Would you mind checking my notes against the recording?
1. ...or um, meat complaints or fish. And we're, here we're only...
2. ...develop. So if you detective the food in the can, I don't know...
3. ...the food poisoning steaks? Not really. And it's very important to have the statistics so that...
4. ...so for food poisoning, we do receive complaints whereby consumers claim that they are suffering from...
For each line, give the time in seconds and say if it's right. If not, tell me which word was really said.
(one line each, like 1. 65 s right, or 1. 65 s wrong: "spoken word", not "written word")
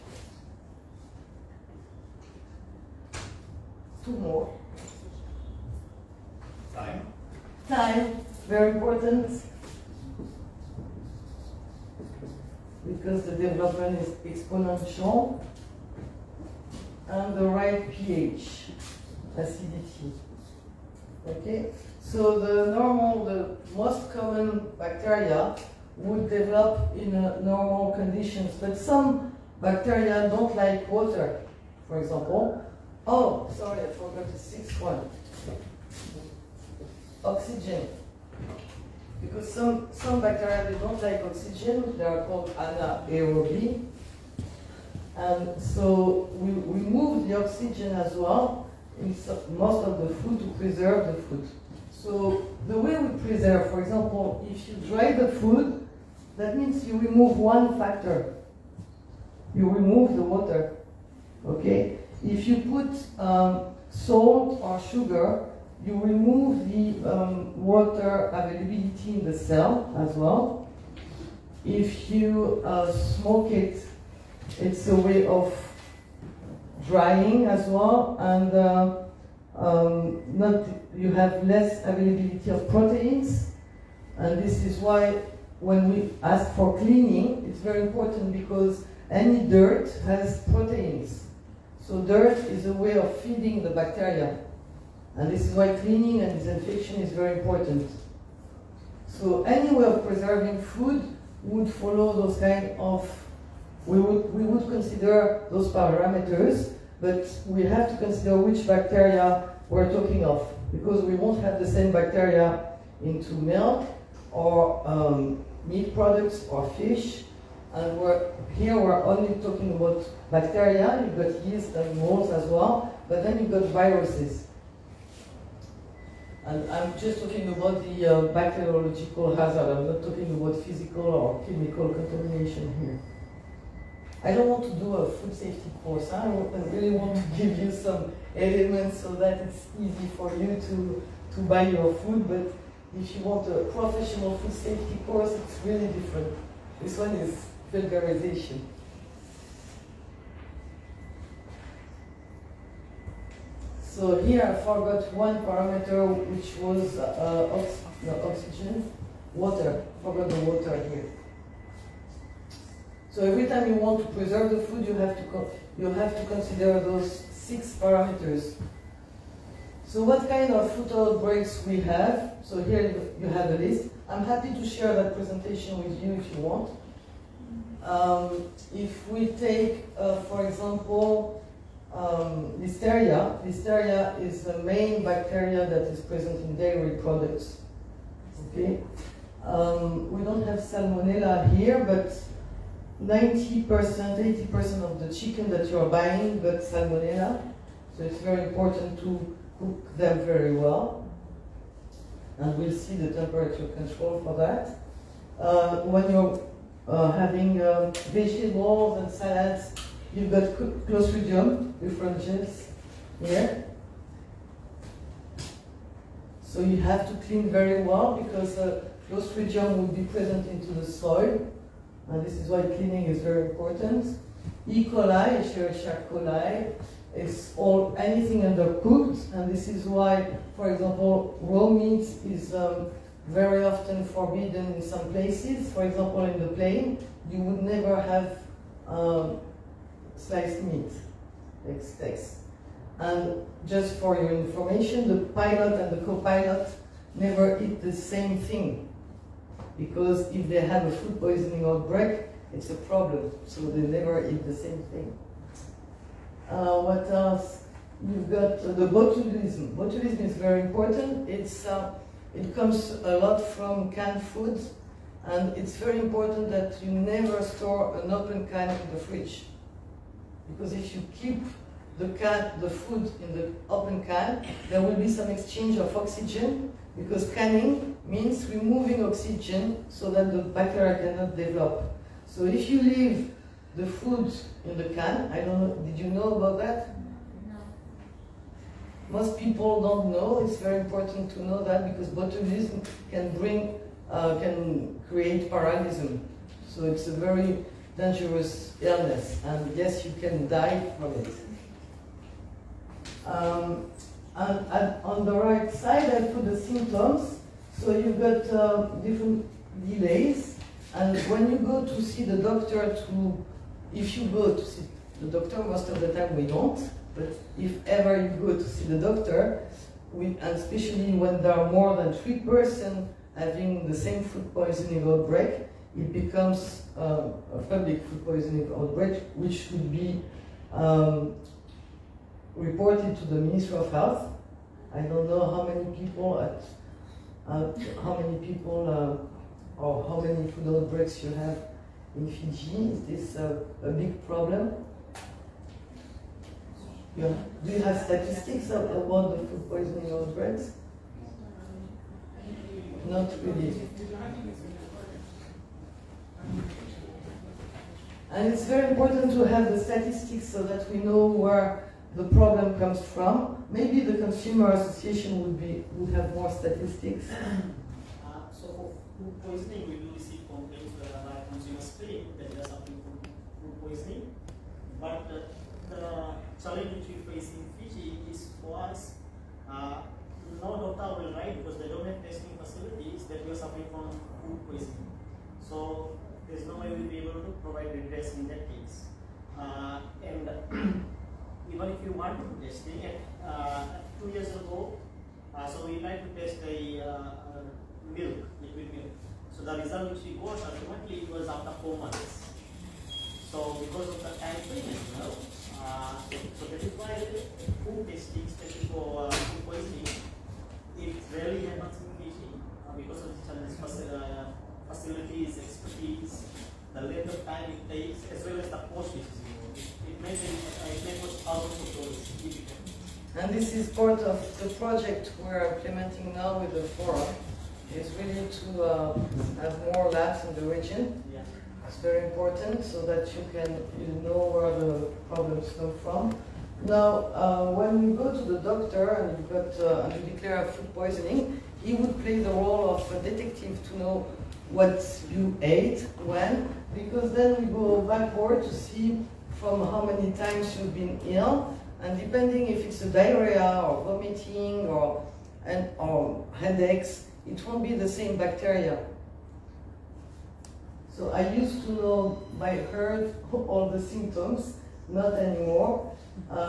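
1. 114 s wrong: "products", not "complaints"
2. 281 s wrong: "leave", not "detective"
3. 349 s wrong: "outbreaks", not "steaks"
4. 368 s right.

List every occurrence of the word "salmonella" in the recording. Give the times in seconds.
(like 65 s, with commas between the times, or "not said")
190 s, 196 s.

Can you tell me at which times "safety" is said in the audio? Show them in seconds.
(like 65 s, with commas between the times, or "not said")
135 s, 144 s.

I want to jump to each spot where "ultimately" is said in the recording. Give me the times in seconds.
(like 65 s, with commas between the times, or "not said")
400 s.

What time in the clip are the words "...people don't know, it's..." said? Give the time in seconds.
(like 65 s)
289 s.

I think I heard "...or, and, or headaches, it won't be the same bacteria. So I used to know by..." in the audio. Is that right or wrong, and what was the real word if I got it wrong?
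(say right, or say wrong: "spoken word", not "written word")
right.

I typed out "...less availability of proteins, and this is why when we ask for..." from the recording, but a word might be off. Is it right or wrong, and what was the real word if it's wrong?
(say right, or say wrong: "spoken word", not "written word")
right.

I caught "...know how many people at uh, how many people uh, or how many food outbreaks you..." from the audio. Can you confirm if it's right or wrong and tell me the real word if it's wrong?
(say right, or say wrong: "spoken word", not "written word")
right.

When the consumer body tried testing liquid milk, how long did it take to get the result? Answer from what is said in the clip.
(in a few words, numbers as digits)
4 months.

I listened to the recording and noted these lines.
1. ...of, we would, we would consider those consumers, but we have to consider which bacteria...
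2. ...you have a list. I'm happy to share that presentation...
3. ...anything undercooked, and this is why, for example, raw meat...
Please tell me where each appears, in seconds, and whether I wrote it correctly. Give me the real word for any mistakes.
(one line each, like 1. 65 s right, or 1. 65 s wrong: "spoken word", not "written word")
1. 102 s wrong: "parameters", not "consumers"
2. 173 s right
3. 227 s right.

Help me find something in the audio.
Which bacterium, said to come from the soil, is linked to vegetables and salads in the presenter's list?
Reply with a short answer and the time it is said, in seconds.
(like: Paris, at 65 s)
Clostridium perfringens, at 210 s.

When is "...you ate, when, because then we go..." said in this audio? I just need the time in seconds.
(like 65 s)
445 s.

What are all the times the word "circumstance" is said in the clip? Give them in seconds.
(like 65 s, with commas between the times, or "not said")
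not said.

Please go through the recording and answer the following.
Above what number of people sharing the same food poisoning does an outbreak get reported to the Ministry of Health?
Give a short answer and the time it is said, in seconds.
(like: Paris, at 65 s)
3, at 322 s.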